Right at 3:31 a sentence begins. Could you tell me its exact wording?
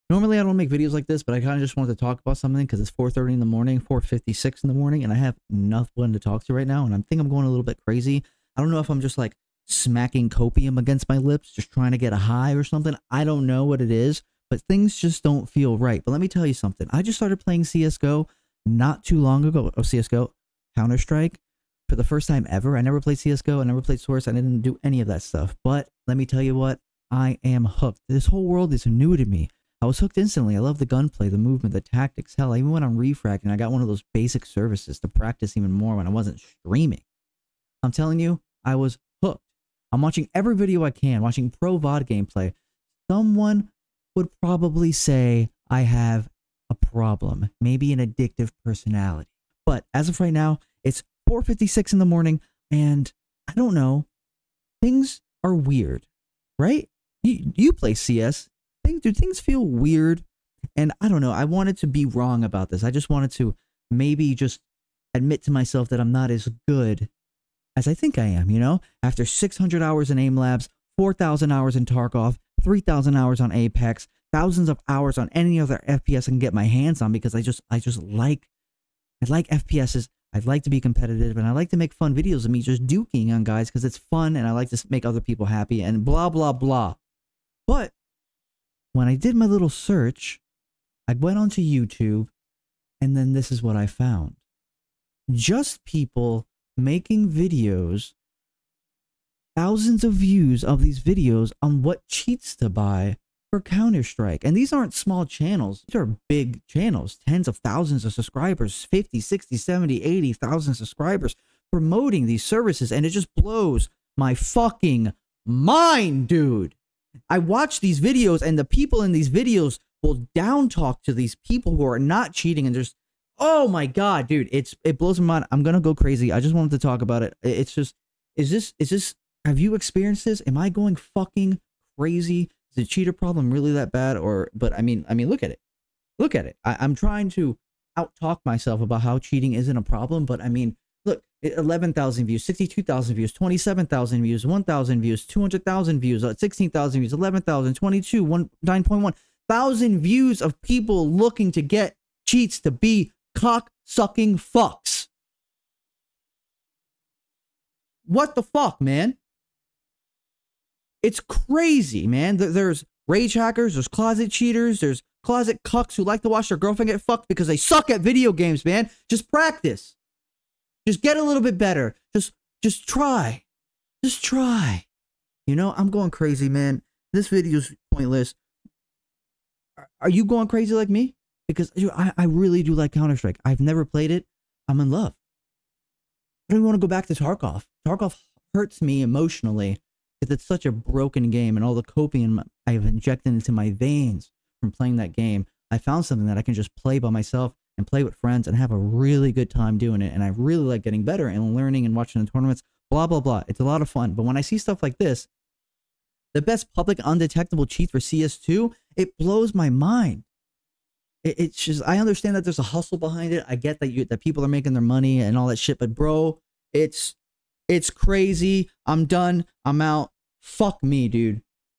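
it's just, I understand that there's a hustle behind it.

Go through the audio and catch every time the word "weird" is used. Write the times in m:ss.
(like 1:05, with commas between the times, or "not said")
0:55, 0:59.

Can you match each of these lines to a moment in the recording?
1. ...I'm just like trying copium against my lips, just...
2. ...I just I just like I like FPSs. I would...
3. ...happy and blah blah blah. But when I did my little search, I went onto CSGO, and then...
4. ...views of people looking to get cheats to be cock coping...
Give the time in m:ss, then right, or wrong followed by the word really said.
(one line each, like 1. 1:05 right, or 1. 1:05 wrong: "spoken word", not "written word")
1. 0:08 wrong: "smacking", not "trying"
2. 1:17 right
3. 1:25 wrong: "YouTube", not "CSGO"
4. 2:29 wrong: "sucking", not "coping".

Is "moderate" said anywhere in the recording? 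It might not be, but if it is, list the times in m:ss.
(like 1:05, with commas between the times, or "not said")
not said.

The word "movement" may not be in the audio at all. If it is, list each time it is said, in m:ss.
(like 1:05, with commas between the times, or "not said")
0:31.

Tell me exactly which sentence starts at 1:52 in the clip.
And it just blows my fucking mind, dude.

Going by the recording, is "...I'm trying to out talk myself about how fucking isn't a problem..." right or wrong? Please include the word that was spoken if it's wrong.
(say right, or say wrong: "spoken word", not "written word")
wrong: "cheating", not "fucking".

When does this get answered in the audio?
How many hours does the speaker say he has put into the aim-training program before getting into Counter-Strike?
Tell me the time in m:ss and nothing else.
1:09.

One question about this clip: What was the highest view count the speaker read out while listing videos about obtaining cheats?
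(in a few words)
200,000.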